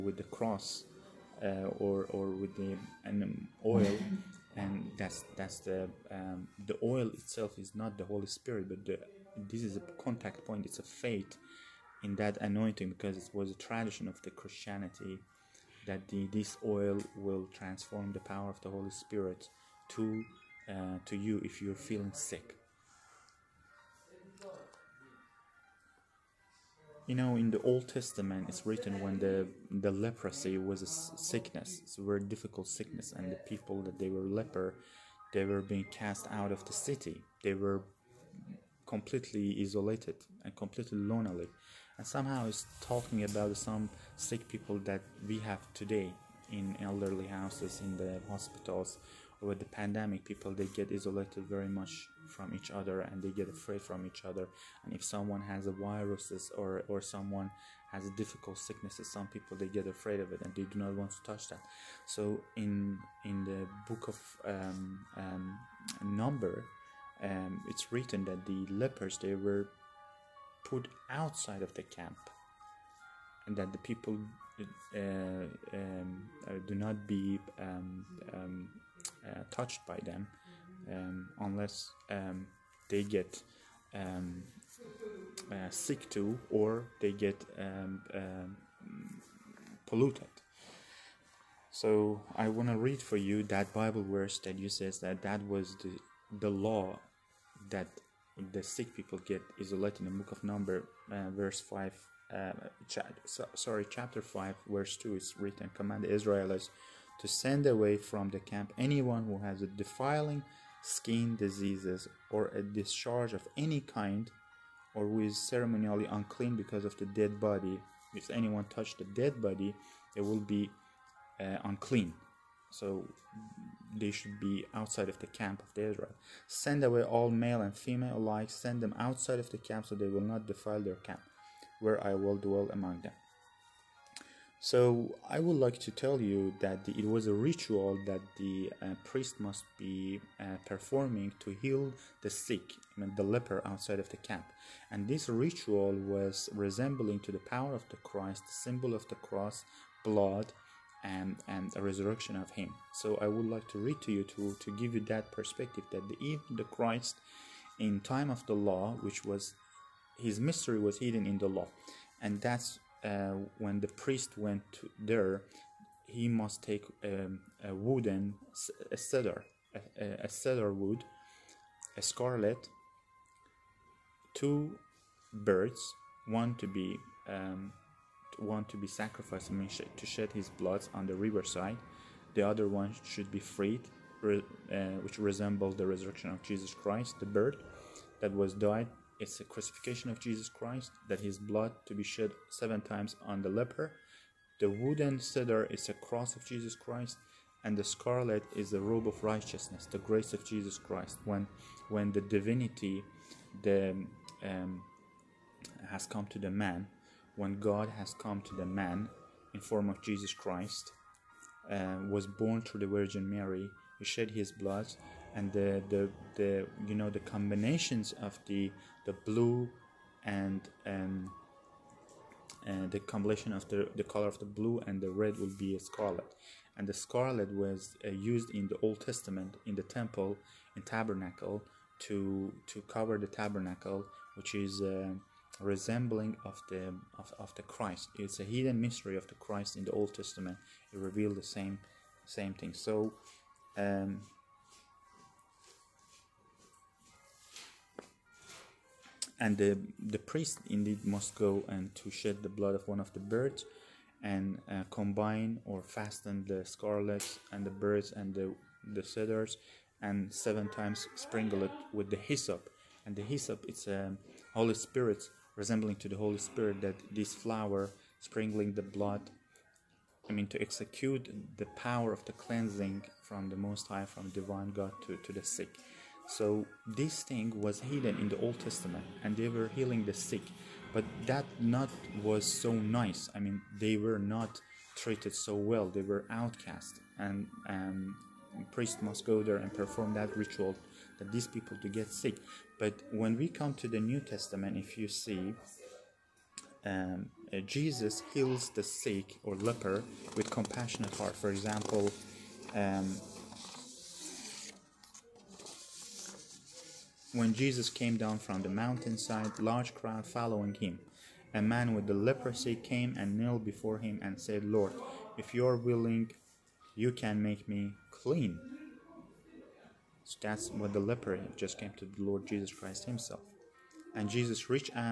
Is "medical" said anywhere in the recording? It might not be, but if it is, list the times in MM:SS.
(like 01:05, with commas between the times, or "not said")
not said.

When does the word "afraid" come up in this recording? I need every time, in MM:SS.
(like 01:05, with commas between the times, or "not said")
00:53, 00:59.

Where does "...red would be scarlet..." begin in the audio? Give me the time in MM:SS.
03:45.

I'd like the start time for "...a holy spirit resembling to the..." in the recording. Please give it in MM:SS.
04:23.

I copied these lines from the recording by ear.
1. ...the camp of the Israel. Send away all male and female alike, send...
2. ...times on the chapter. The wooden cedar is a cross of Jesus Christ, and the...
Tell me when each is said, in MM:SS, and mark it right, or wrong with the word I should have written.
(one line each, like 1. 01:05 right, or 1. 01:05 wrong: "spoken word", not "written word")
1. 02:05 right
2. 03:12 wrong: "leper", not "chapter".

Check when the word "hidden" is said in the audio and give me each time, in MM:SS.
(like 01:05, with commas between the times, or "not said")
02:40, 03:58, 04:37.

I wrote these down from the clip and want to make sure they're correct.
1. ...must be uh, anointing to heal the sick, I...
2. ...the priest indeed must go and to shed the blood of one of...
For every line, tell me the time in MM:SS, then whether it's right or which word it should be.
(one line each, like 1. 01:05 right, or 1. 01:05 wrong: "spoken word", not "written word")
1. 02:19 wrong: "performing", not "anointing"
2. 04:09 right.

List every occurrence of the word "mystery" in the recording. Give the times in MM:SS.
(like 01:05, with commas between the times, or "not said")
02:40, 03:58.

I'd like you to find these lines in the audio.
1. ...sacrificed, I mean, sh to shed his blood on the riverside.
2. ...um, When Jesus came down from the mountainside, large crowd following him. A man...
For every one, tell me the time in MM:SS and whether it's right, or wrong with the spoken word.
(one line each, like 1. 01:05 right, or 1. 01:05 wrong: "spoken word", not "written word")
1. 02:58 right
2. 05:02 right.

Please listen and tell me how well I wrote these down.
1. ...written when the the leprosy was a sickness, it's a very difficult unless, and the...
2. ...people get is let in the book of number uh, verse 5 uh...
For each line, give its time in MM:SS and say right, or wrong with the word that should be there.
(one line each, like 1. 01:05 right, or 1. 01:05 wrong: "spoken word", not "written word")
1. 00:28 wrong: "sickness", not "unless"
2. 01:38 right.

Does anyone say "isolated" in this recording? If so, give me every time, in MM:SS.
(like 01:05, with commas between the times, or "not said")
00:39, 00:50.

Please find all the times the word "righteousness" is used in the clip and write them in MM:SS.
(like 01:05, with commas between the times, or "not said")
03:19.